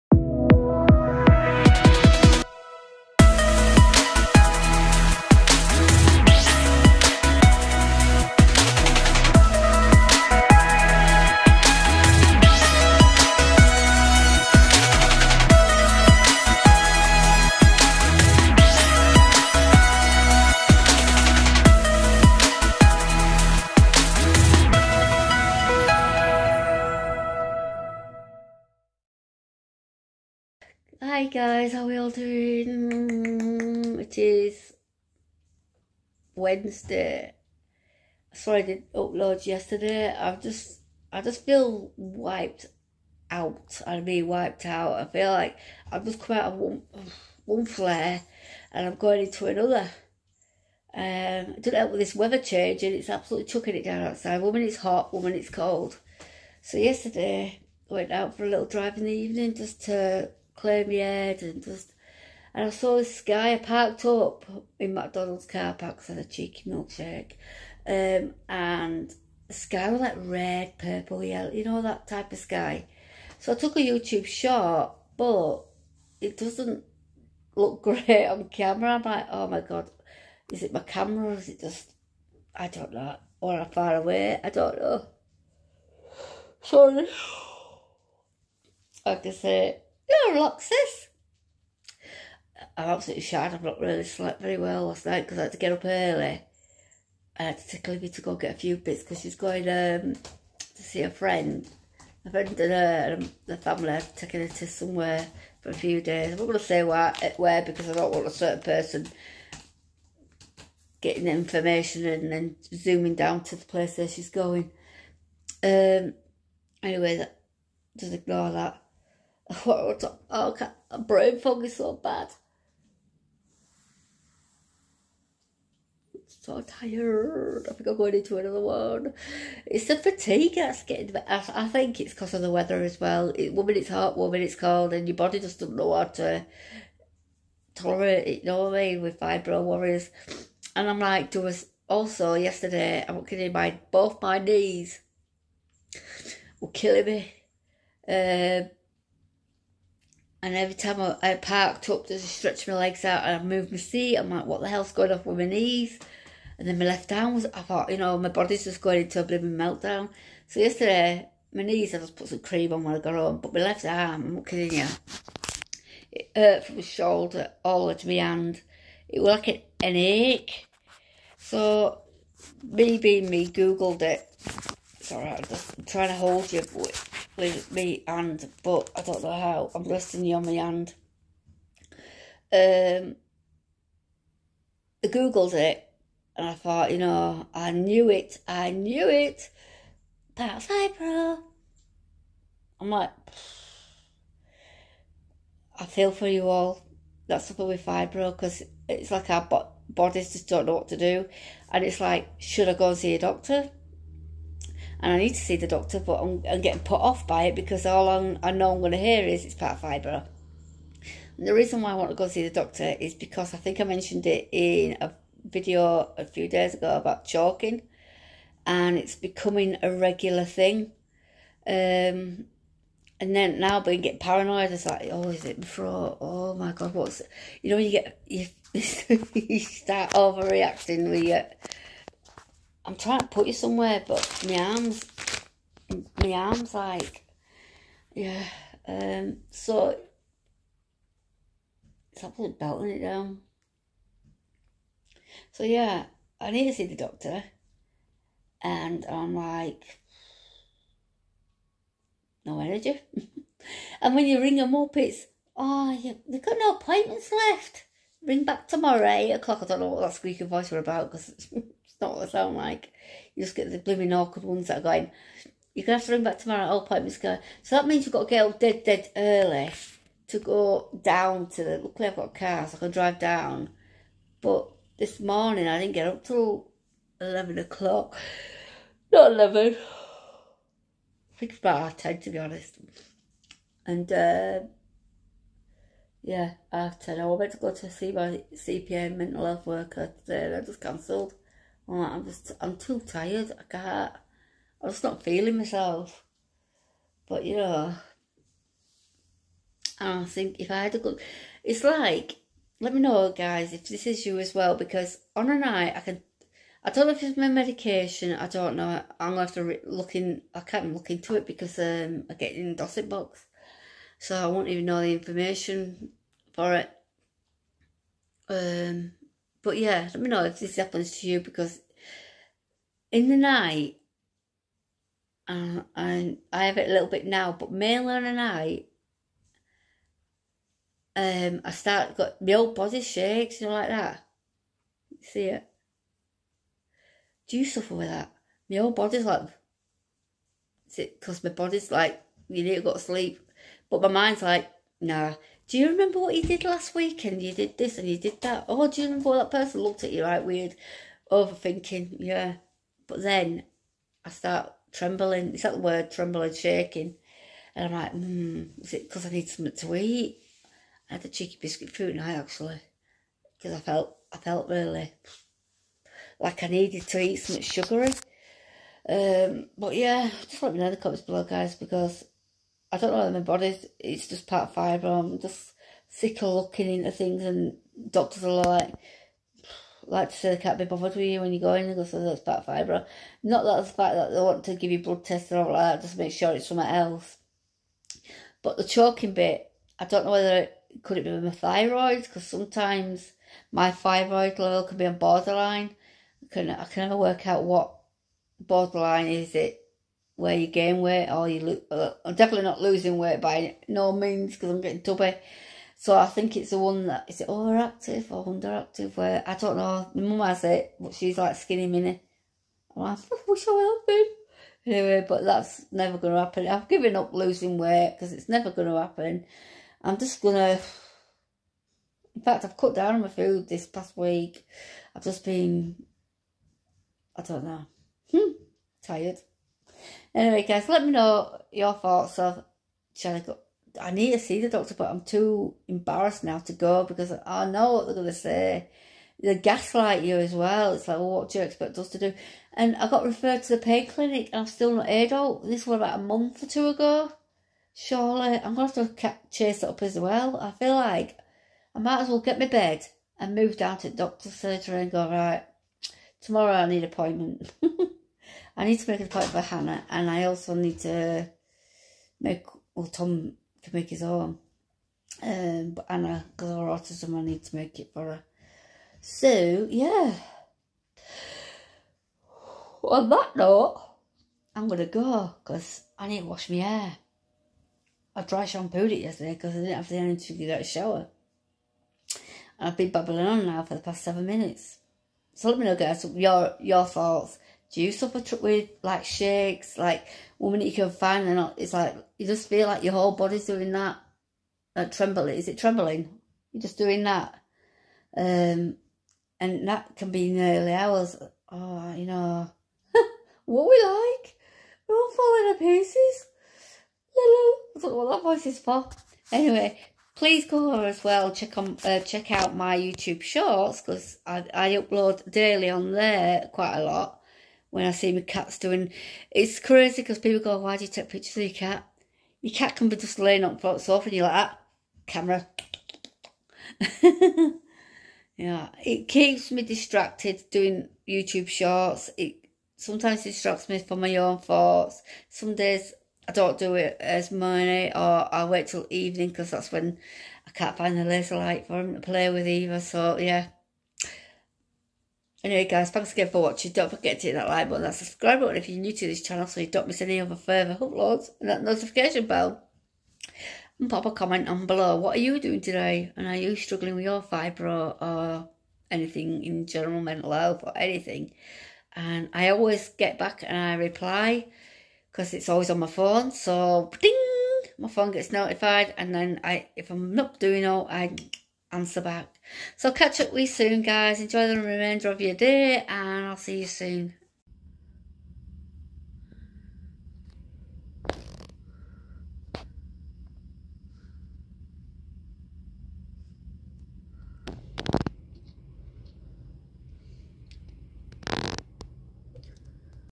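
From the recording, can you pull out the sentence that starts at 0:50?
Um I do not help with this weather change and it's absolutely chucking it down outside.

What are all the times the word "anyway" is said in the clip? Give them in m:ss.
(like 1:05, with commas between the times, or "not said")
1:56, 6:54, 7:10, 8:29, 9:05.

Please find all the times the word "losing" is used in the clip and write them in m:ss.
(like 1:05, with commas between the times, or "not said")
6:42, 6:57.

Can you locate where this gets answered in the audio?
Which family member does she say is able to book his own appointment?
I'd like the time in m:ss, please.
7:43.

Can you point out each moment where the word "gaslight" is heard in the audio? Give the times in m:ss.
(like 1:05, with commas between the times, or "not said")
7:19.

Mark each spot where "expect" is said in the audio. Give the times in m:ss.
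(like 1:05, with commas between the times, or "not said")
7:21.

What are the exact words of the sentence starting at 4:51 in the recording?
I'm like, I'm just, I'm too tired.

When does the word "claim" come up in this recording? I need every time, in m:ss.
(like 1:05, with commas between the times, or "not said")
1:00.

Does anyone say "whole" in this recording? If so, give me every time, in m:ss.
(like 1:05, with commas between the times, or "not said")
5:38, 8:13.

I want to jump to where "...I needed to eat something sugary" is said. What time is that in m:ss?
6:06.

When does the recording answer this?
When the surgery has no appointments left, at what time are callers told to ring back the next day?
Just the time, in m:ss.
4:19.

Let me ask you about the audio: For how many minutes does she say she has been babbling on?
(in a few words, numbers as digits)
7.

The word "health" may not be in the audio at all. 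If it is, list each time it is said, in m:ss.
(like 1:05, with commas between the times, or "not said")
4:49, 9:20.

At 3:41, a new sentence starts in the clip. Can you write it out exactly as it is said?
Um, and then now being get paranoid, it's like, oh, is it before?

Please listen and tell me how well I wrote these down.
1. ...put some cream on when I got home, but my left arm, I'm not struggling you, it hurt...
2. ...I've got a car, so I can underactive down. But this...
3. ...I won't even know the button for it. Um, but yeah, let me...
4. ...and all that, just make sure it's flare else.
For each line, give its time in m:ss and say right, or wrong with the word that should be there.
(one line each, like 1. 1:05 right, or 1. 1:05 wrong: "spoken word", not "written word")
1. 2:42 wrong: "kidding", not "struggling"
2. 4:32 wrong: "drive", not "underactive"
3. 5:14 wrong: "information", not "button"
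4. 6:25 wrong: "somewhere", not "flare".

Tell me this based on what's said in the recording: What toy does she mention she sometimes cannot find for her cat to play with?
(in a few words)
Laser light.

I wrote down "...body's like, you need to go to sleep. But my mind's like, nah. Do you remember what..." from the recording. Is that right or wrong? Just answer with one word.
right.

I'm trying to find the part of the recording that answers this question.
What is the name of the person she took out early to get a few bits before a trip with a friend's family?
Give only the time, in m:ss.
1:37.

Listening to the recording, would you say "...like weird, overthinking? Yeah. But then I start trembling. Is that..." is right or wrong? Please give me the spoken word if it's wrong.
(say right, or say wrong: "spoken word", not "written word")
right.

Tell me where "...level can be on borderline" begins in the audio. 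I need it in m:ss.
6:34.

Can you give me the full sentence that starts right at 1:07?
Um, and the sky was like red, purple, yellow, you know, that type of sky.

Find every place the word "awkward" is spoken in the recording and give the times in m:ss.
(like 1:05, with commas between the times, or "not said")
4:24.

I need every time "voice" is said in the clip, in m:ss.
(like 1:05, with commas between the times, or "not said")
4:20, 8:28.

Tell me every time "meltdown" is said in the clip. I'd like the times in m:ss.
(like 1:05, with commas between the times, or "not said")
2:39.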